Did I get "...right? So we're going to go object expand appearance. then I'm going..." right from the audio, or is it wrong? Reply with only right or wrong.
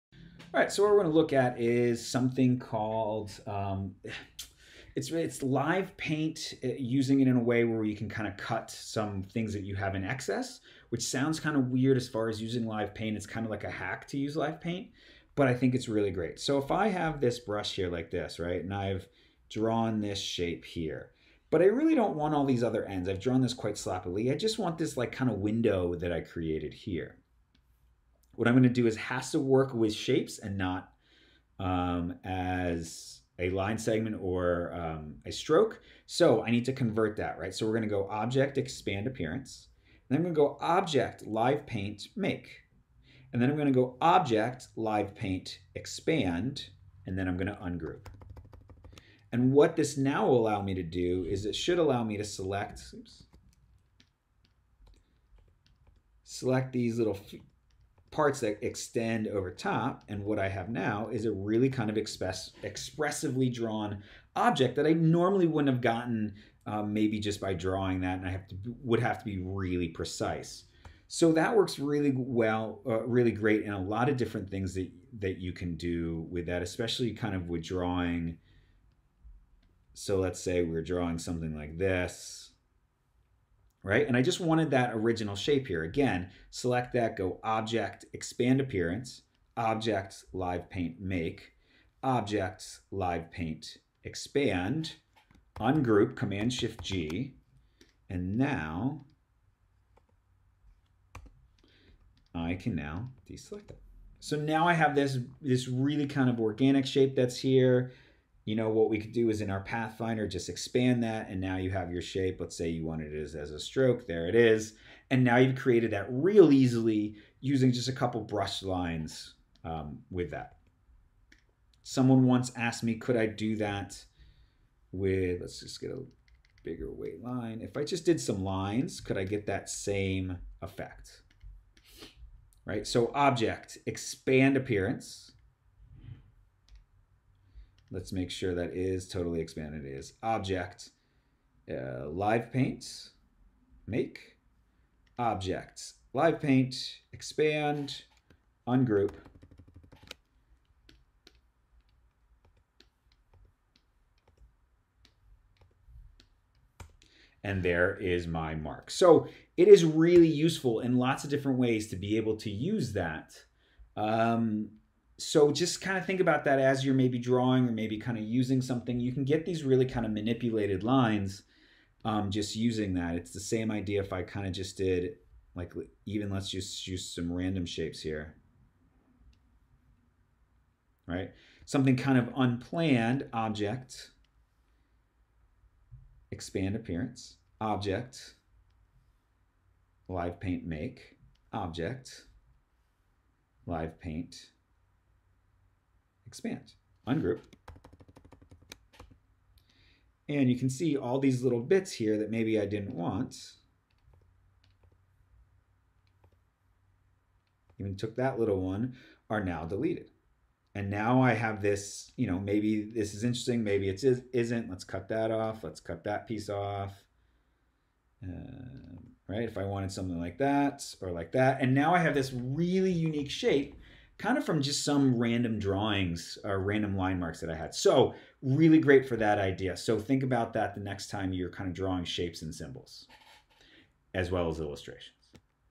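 right.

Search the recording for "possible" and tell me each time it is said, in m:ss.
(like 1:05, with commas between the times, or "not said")
not said.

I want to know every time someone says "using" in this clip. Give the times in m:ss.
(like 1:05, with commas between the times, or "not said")
0:06, 0:12, 1:57, 2:48, 2:52.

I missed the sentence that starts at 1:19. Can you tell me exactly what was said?
So let's say we're drawing something like this right?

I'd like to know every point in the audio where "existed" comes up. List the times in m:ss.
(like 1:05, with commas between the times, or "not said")
not said.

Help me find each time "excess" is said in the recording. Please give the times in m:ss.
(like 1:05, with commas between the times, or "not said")
0:10.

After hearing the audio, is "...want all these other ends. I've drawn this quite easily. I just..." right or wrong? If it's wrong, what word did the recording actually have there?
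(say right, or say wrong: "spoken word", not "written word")
wrong: "sloppily", not "easily".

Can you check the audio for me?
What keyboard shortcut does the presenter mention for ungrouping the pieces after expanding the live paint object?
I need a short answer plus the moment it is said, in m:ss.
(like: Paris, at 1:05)
Command-Shift-G, at 1:36.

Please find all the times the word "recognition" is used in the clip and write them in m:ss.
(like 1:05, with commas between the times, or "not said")
not said.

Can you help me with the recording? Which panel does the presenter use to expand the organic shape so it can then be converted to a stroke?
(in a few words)
Pathfinder.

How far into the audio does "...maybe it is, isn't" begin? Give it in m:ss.
3:33.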